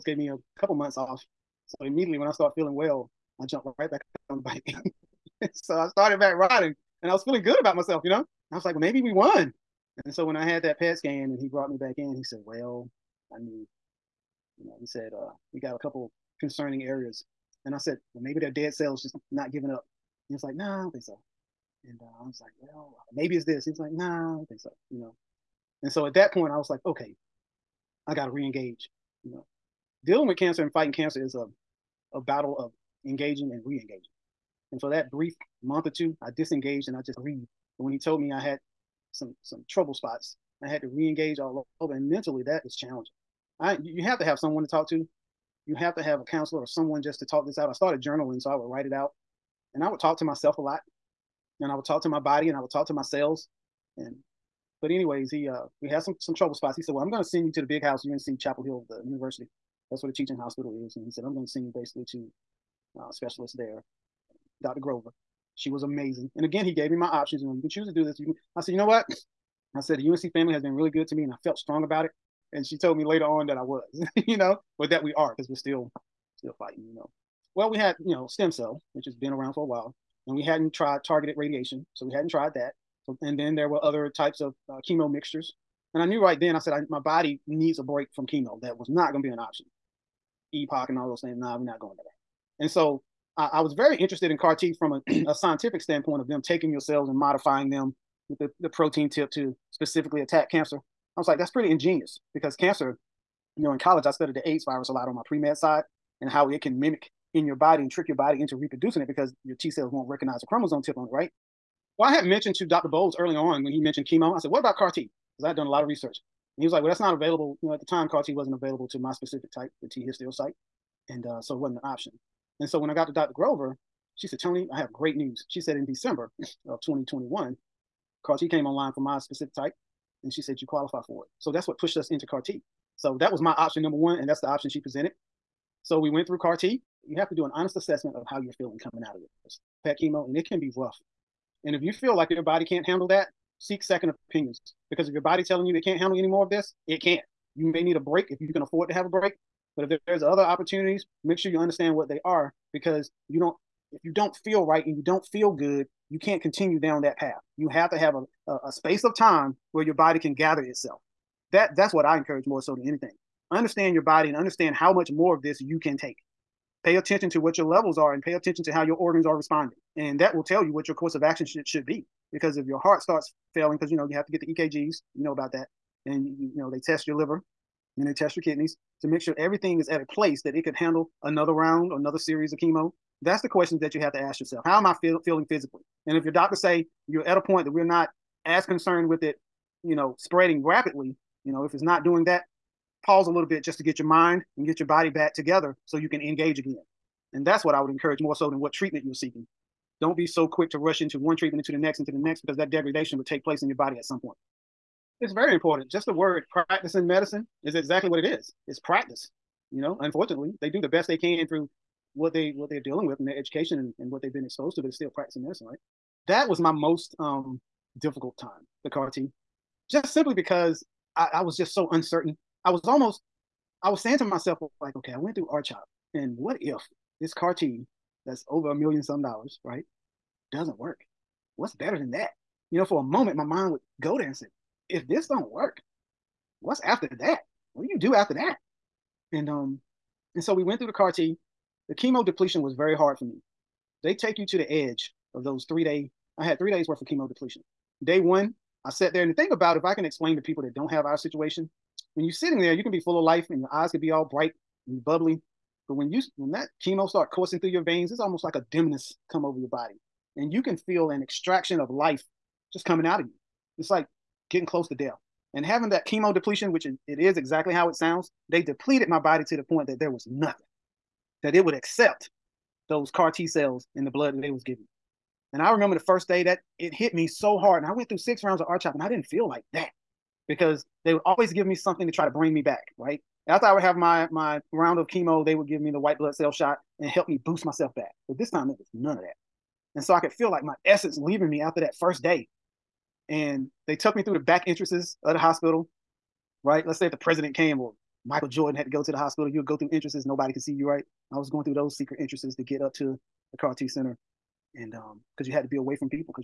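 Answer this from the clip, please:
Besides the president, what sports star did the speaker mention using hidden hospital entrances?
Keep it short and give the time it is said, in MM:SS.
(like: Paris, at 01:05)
Michael Jordan, at 04:58.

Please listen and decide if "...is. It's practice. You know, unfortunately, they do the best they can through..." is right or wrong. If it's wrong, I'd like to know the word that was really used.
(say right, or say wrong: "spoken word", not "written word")
right.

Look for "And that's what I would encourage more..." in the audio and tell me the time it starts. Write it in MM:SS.
03:17.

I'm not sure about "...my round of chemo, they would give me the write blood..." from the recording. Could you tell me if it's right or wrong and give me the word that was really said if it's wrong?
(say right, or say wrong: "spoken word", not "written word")
wrong: "white", not "write".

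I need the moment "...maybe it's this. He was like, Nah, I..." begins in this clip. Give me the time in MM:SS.
00:23.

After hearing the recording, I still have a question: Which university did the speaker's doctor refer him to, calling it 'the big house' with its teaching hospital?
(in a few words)
UNC Chapel Hill.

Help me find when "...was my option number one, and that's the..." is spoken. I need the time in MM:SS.
02:13.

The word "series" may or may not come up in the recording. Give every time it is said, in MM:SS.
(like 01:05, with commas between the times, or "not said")
03:02.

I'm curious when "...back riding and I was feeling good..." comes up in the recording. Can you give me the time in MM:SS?
00:06.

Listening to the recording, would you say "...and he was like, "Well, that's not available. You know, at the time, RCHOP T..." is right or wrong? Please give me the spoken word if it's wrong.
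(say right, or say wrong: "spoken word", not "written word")
wrong: "CAR", not "RCHOP".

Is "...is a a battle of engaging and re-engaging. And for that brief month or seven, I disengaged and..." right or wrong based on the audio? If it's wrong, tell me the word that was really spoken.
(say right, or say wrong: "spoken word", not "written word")
wrong: "two", not "seven".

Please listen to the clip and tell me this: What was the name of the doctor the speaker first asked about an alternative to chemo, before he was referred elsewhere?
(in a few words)
Dr. Bowles.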